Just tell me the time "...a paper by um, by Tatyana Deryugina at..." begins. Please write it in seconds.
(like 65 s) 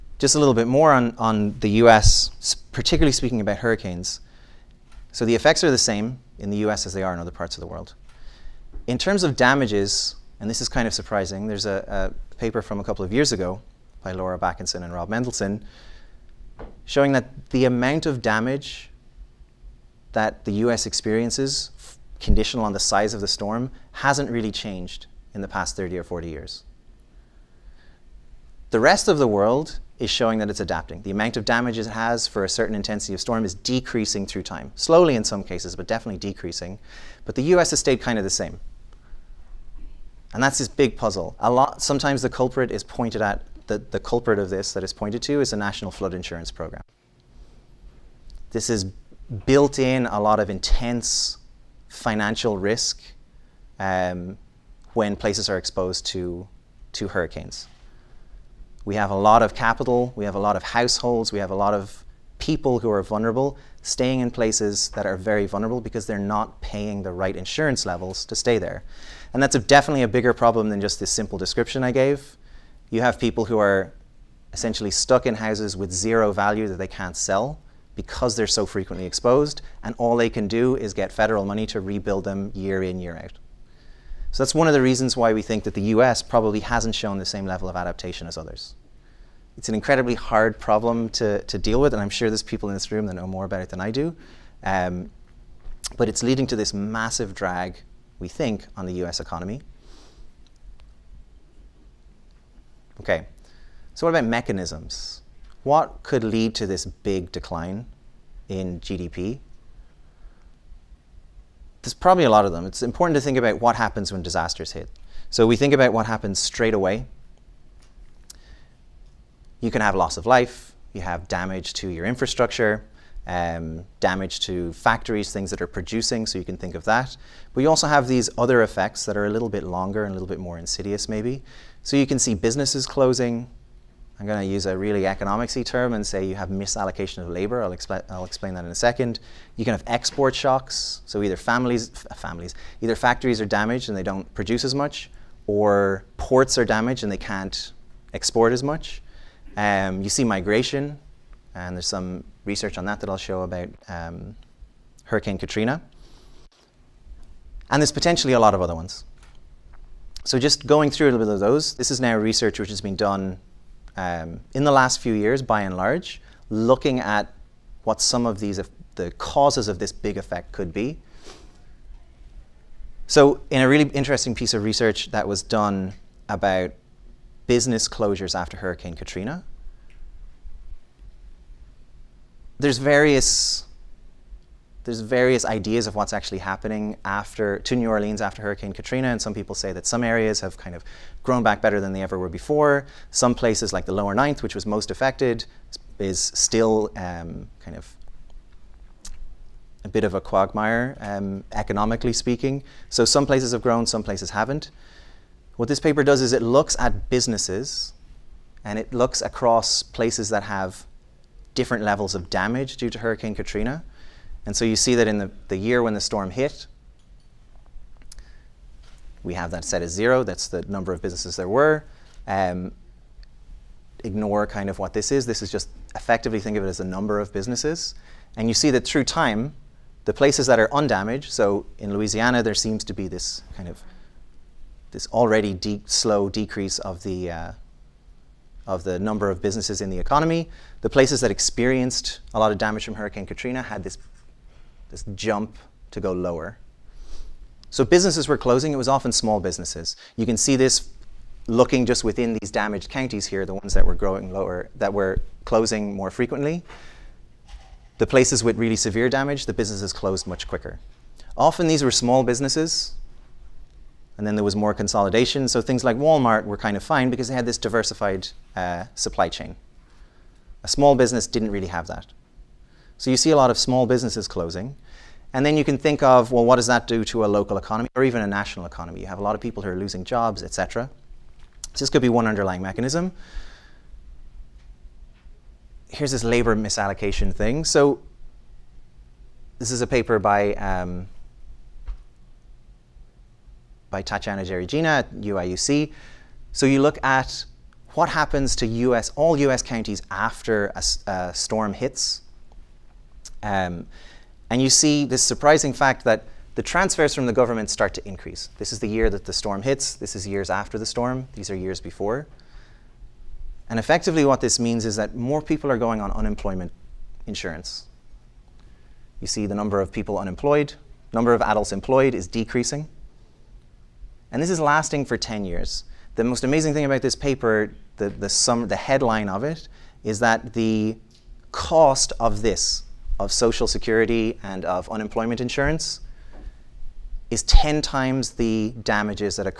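289 s.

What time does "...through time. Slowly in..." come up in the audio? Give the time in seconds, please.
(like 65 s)
34 s.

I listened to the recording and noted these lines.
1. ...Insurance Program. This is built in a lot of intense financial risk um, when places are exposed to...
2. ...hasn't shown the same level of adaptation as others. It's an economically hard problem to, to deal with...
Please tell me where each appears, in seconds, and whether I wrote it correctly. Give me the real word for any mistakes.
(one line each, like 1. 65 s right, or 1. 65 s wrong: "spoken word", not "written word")
1. 46 s right
2. 86 s wrong: "incredibly", not "economically".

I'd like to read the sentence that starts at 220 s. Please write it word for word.
That's the number of businesses there were.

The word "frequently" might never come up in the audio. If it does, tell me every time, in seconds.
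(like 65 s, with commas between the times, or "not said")
78 s, 256 s.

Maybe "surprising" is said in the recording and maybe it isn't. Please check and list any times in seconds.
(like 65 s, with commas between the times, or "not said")
10 s, 305 s.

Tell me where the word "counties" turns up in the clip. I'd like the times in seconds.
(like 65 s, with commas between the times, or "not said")
252 s, 299 s.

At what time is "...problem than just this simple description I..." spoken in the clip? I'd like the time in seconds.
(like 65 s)
70 s.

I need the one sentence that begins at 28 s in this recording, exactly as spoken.
The rest of the world is showing that it's adapting.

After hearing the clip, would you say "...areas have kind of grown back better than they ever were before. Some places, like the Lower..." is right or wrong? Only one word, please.
right.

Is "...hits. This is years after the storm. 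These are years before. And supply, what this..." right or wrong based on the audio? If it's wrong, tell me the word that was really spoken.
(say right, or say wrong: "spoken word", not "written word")
wrong: "effectively", not "supply".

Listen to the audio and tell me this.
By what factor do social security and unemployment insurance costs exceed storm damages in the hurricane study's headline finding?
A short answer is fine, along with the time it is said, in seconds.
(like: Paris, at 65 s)
10, at 337 s.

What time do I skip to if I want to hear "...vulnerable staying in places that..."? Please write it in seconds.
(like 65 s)
63 s.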